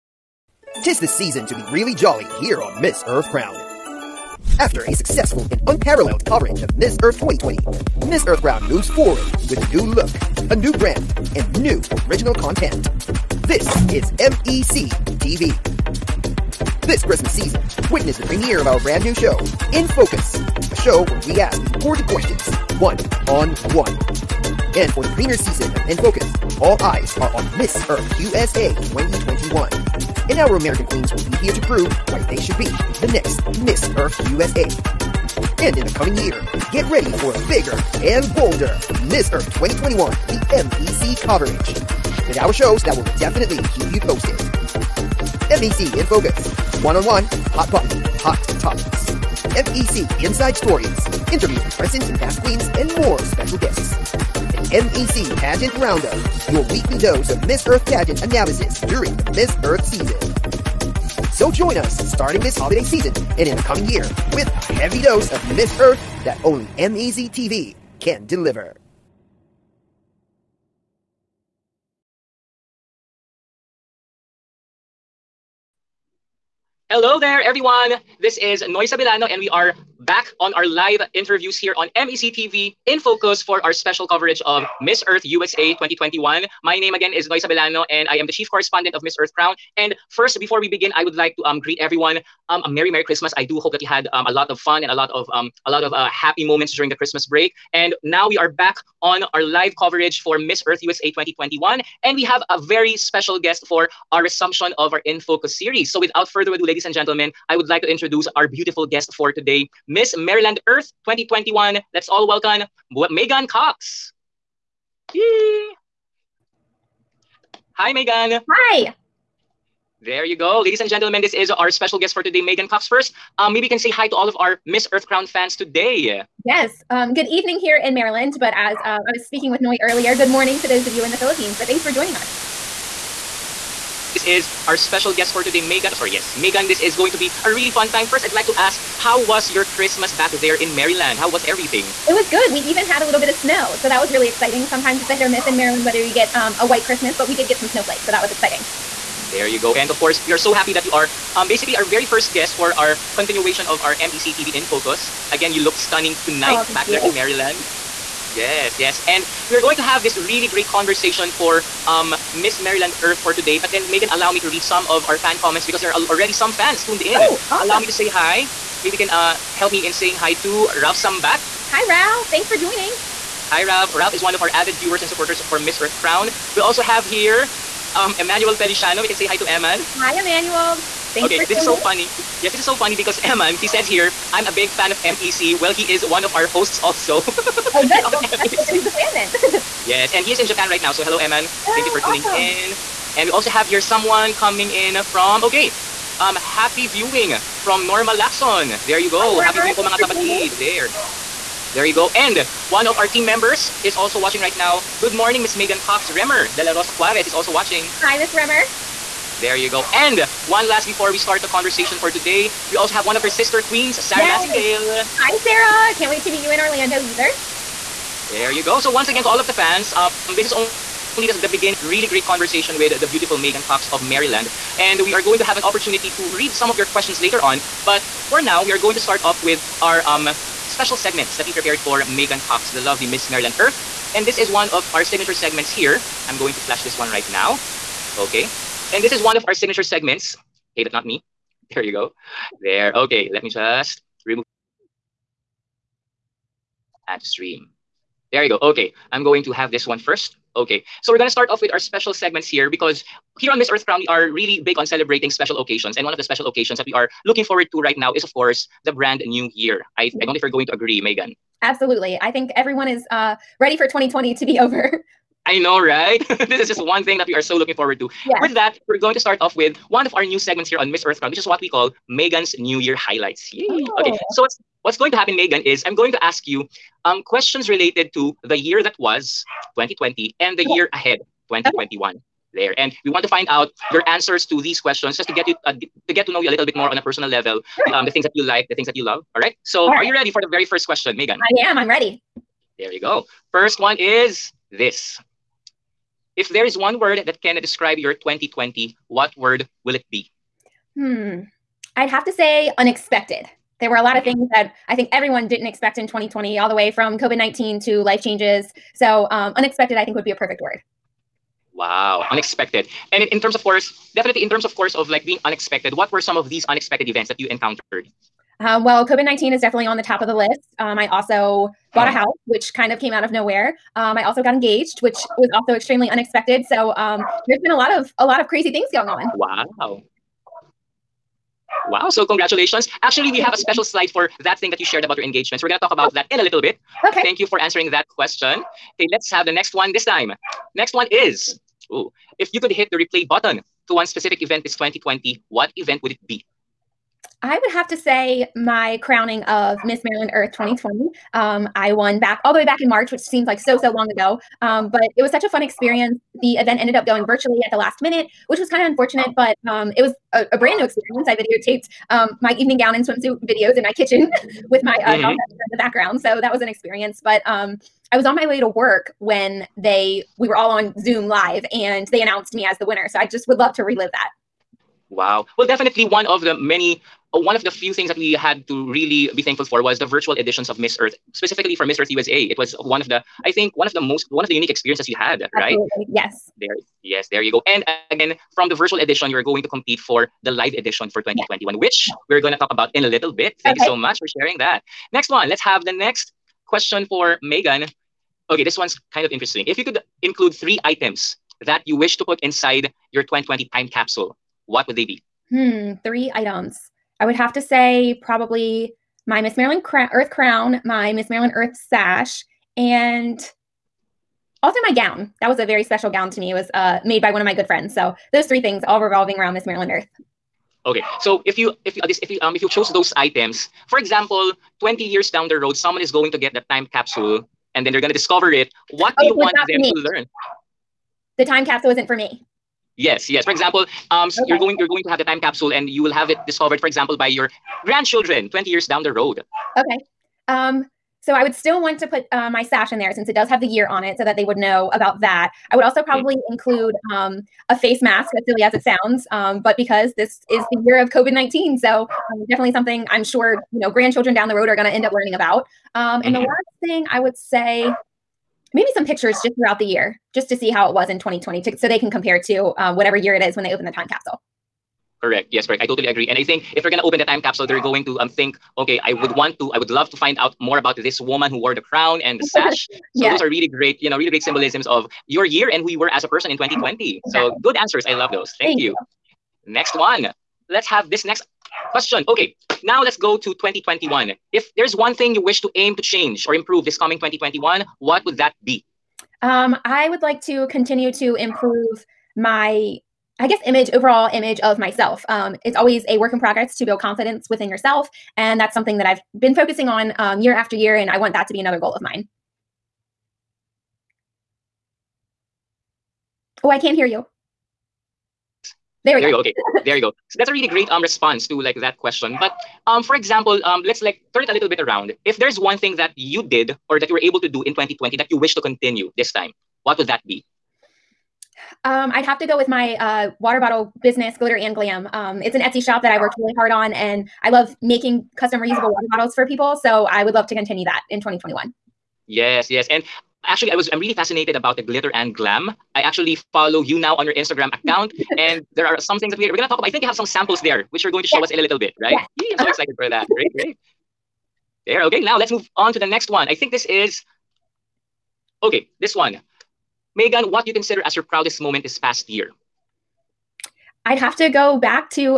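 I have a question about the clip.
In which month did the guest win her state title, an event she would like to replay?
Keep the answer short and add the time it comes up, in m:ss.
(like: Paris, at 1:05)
March, at 5:52.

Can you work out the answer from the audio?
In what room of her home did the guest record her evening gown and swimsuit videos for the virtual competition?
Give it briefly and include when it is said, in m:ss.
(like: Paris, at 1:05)
kitchen, at 6:03.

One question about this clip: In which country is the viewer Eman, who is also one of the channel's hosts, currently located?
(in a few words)
Japan.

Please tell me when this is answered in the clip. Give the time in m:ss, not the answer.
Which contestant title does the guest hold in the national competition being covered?
1:49.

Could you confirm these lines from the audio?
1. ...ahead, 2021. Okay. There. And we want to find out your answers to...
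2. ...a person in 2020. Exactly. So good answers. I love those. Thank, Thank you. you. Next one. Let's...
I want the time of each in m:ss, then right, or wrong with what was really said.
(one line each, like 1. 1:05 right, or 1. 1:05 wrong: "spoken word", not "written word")
1. 4:40 right
2. 7:56 right.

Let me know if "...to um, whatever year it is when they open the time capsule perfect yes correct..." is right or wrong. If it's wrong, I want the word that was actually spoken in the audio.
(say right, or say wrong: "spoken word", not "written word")
wrong: "correct", not "perfect".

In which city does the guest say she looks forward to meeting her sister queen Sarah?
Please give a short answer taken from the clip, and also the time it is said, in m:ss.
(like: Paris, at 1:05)
Orlando, at 3:36.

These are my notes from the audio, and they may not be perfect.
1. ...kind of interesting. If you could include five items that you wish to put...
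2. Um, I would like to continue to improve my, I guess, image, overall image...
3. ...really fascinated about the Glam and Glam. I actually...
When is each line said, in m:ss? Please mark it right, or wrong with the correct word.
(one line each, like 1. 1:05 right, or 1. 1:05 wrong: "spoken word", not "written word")
1. 6:39 wrong: "three", not "five"
2. 8:09 right
3. 8:53 wrong: "Glitter", not "Glam".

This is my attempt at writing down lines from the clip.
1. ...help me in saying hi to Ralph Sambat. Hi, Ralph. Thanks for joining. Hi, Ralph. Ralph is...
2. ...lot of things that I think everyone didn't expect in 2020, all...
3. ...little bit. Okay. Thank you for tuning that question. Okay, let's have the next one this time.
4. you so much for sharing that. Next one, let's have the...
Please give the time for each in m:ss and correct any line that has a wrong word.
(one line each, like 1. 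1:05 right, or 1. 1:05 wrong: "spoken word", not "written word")
1. 2:49 right
2. 5:04 right
3. 5:36 wrong: "answering", not "tuning"
4. 6:33 right.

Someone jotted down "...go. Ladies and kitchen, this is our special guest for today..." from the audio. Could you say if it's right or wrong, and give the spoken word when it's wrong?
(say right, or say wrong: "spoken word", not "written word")
wrong: "gentlemen", not "kitchen".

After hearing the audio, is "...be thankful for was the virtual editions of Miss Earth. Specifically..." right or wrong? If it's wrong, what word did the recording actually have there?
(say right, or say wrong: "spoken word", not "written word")
right.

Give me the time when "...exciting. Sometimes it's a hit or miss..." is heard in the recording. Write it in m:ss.
2:24.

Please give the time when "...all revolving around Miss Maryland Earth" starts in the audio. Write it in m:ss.
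6:58.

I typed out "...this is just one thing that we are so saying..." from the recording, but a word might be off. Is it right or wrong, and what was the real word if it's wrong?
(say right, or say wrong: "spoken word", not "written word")
wrong: "looking", not "saying".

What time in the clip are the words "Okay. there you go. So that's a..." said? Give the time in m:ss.
8:29.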